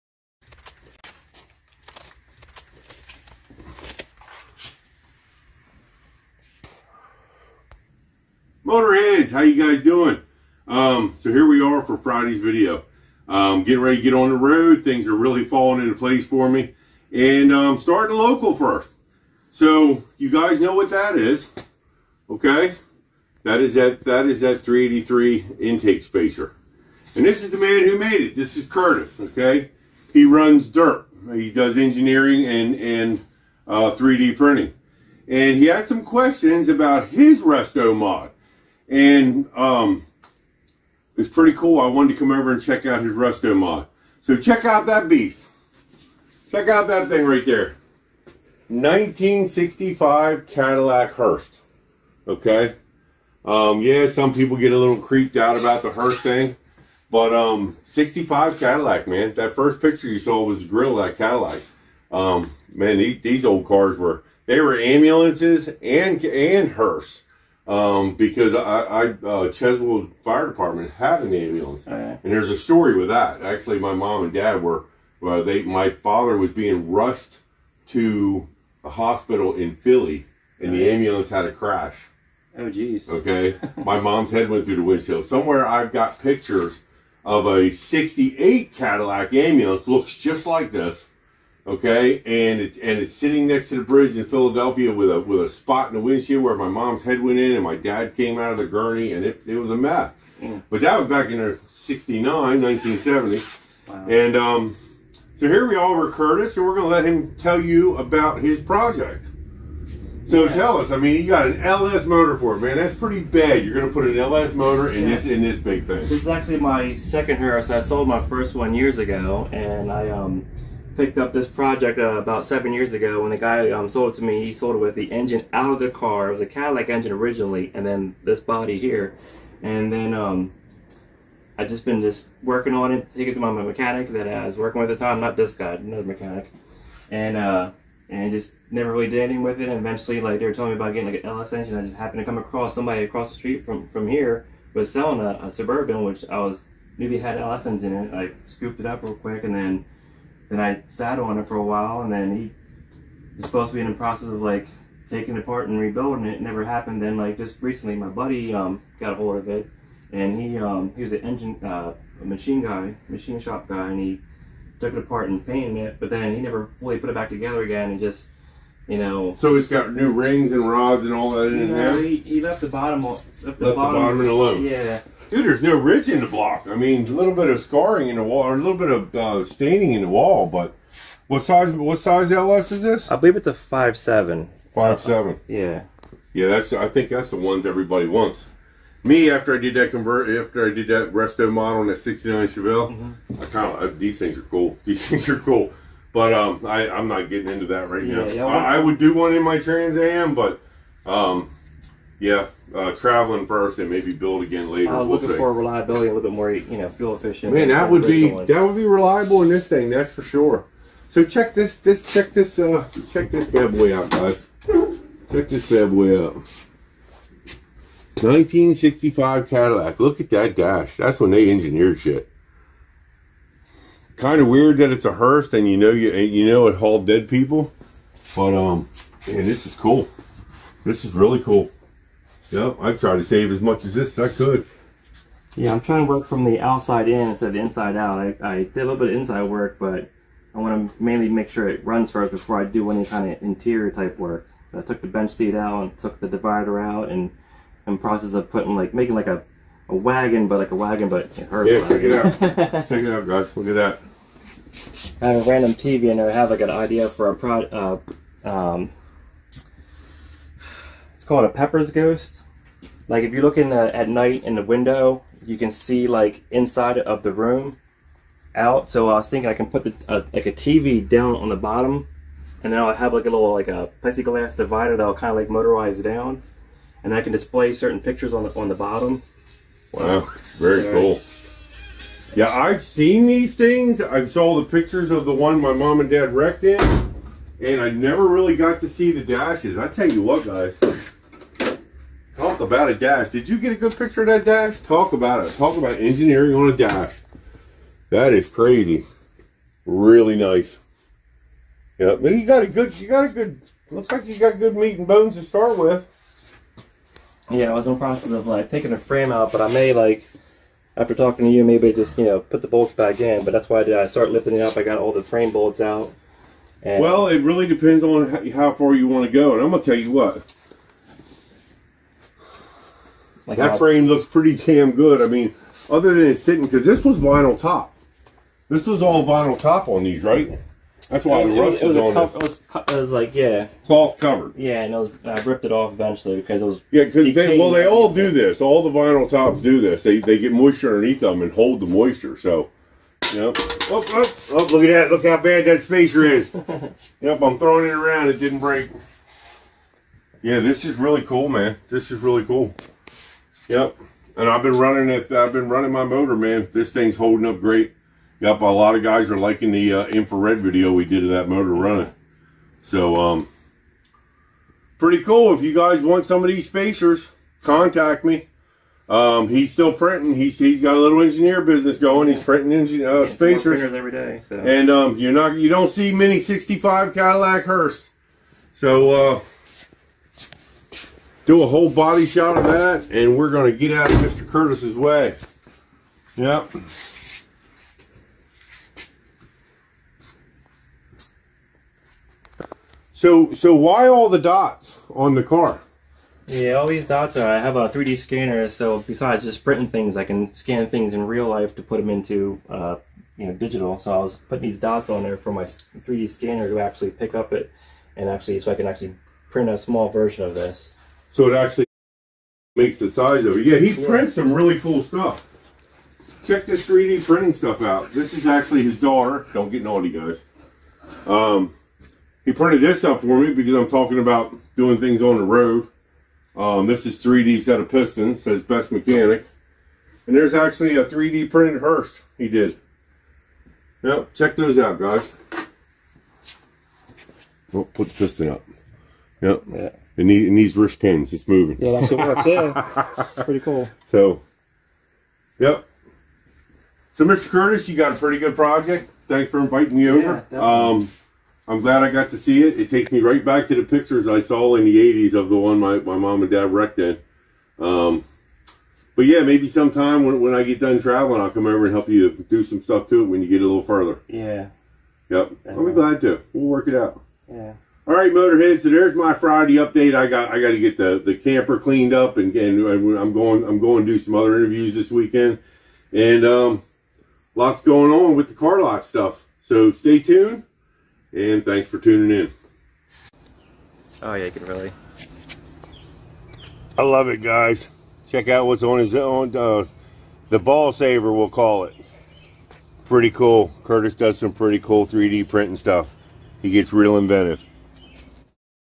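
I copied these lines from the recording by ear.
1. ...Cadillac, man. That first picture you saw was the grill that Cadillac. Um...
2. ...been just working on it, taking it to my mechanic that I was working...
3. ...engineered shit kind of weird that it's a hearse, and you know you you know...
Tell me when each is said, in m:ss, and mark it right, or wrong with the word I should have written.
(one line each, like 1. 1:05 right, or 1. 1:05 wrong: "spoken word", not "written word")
1. 0:58 right
2. 2:11 right
3. 3:41 right.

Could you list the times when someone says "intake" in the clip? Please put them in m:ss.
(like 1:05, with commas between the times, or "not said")
0:25.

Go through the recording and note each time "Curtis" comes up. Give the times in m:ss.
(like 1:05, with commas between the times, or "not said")
0:28, 1:46, 6:24, 7:27, 8:13.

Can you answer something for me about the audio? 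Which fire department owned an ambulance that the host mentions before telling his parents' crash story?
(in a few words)
Cheswold Fire Department.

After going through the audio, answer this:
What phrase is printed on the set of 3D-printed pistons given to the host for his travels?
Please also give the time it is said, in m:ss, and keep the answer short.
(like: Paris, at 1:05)
Best Mechanic, at 7:08.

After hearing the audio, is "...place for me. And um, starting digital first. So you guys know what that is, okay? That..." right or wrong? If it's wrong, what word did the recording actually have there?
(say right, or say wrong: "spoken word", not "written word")
wrong: "local", not "digital".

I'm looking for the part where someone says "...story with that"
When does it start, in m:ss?
1:12.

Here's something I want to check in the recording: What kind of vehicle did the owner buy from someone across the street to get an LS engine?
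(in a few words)
Suburban.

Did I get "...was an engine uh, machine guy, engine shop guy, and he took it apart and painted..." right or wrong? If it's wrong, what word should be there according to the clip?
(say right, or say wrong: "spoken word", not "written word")
wrong: "machine", not "engine".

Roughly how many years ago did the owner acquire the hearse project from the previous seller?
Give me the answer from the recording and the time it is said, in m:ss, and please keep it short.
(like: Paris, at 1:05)
7 years, at 2:02.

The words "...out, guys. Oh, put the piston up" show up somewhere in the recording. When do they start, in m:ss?
7:14.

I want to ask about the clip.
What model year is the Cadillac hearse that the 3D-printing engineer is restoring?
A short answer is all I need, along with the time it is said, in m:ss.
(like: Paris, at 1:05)
1965, at 0:48.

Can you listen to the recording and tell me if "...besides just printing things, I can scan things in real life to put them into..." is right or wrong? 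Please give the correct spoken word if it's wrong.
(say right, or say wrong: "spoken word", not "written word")
right.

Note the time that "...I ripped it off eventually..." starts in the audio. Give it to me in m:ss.
5:35.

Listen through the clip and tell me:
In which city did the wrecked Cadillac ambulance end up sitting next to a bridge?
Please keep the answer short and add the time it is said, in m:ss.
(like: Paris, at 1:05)
Philadelphia, at 1:34.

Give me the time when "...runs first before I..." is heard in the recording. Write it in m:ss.
4:01.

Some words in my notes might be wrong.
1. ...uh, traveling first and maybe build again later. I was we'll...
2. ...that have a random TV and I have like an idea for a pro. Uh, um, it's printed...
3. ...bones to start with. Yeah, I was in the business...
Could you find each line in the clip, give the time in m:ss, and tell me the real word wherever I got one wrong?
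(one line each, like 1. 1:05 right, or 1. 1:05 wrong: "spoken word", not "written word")
1. 3:22 right
2. 4:13 wrong: "called", not "printed"
3. 5:05 wrong: "process", not "business".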